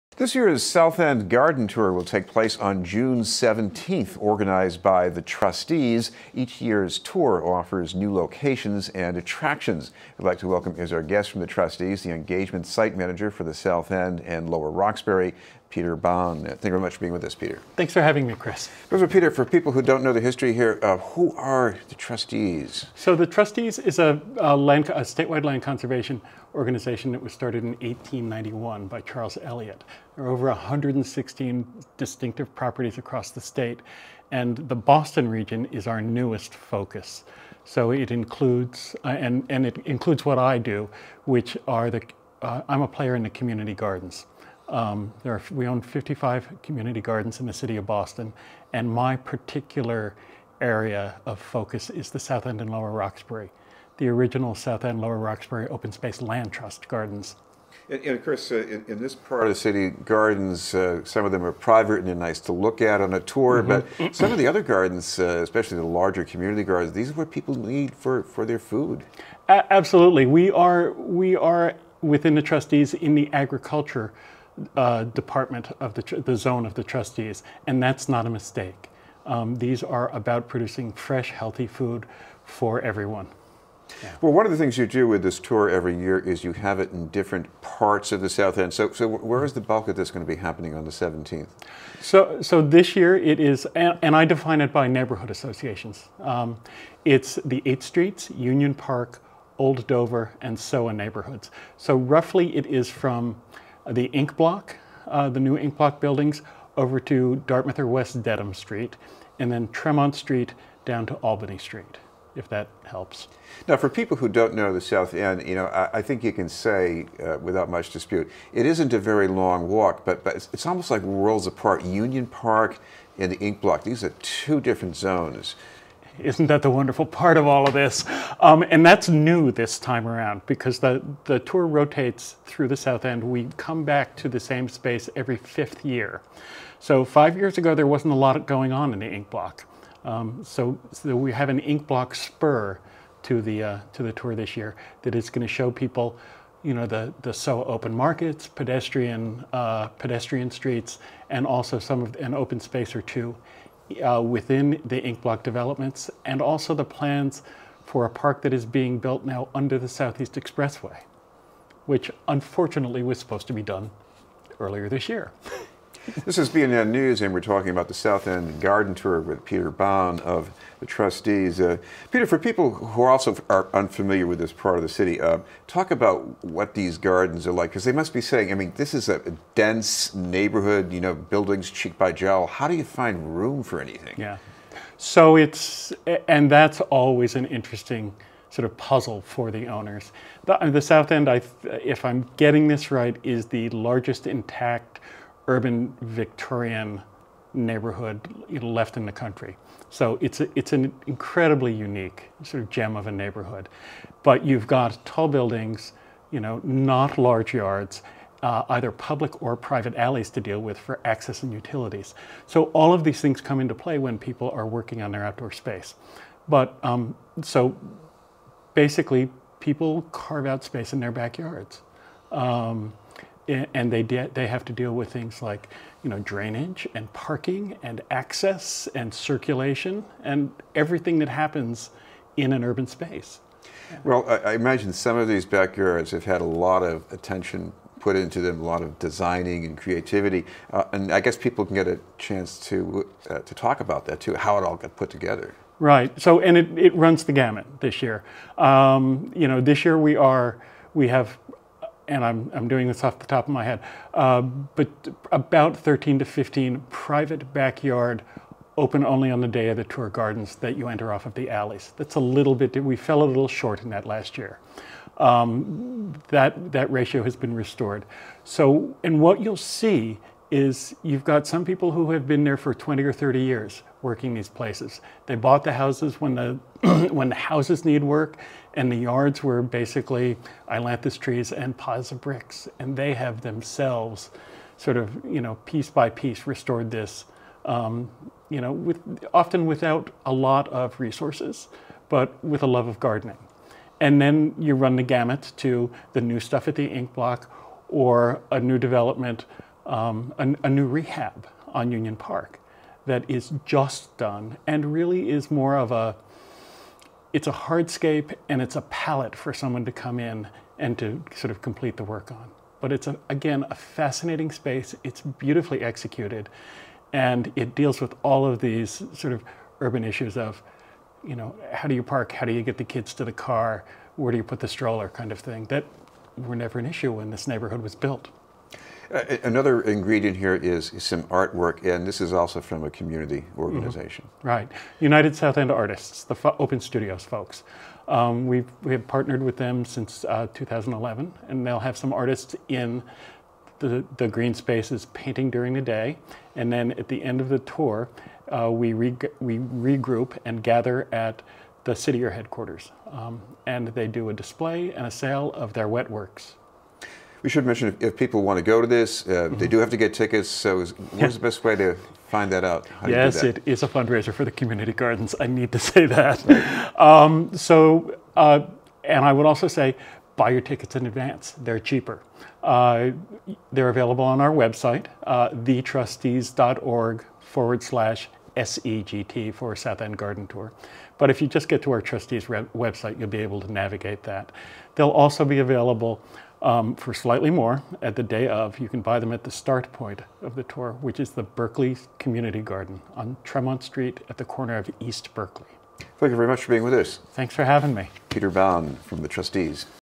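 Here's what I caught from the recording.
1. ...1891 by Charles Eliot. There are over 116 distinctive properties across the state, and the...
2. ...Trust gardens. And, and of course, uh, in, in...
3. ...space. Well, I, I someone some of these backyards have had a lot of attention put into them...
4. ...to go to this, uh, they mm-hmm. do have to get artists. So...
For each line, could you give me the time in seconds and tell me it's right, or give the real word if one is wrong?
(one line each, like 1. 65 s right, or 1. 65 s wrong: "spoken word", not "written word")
1. 27 s right
2. 56 s right
3. 232 s wrong: "imagine", not "someone"
4. 358 s wrong: "tickets", not "artists".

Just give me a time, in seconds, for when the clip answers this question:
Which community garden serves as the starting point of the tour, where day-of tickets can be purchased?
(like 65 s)
391 s.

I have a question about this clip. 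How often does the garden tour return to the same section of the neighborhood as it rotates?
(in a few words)
Every fifth year.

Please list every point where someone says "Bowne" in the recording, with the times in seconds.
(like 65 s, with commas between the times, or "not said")
15 s, 169 s, 398 s.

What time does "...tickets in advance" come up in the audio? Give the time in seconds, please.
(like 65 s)
370 s.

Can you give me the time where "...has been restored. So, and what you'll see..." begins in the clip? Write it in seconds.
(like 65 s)
267 s.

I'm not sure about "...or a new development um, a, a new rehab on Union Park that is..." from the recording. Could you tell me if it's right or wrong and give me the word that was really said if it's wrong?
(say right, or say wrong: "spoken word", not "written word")
right.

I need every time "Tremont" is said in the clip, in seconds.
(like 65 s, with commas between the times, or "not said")
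109 s, 393 s.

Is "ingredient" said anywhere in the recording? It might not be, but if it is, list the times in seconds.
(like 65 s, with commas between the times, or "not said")
329 s.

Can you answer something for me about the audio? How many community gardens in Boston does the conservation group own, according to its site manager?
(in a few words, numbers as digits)
55.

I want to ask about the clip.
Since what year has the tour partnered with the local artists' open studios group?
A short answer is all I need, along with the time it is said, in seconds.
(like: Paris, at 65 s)
2011, at 340 s.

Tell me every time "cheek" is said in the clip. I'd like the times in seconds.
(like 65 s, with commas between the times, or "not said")
181 s.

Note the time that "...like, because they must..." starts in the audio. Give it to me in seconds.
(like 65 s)
177 s.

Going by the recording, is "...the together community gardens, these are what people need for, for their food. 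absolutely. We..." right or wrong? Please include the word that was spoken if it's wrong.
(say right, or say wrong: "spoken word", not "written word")
wrong: "larger", not "together".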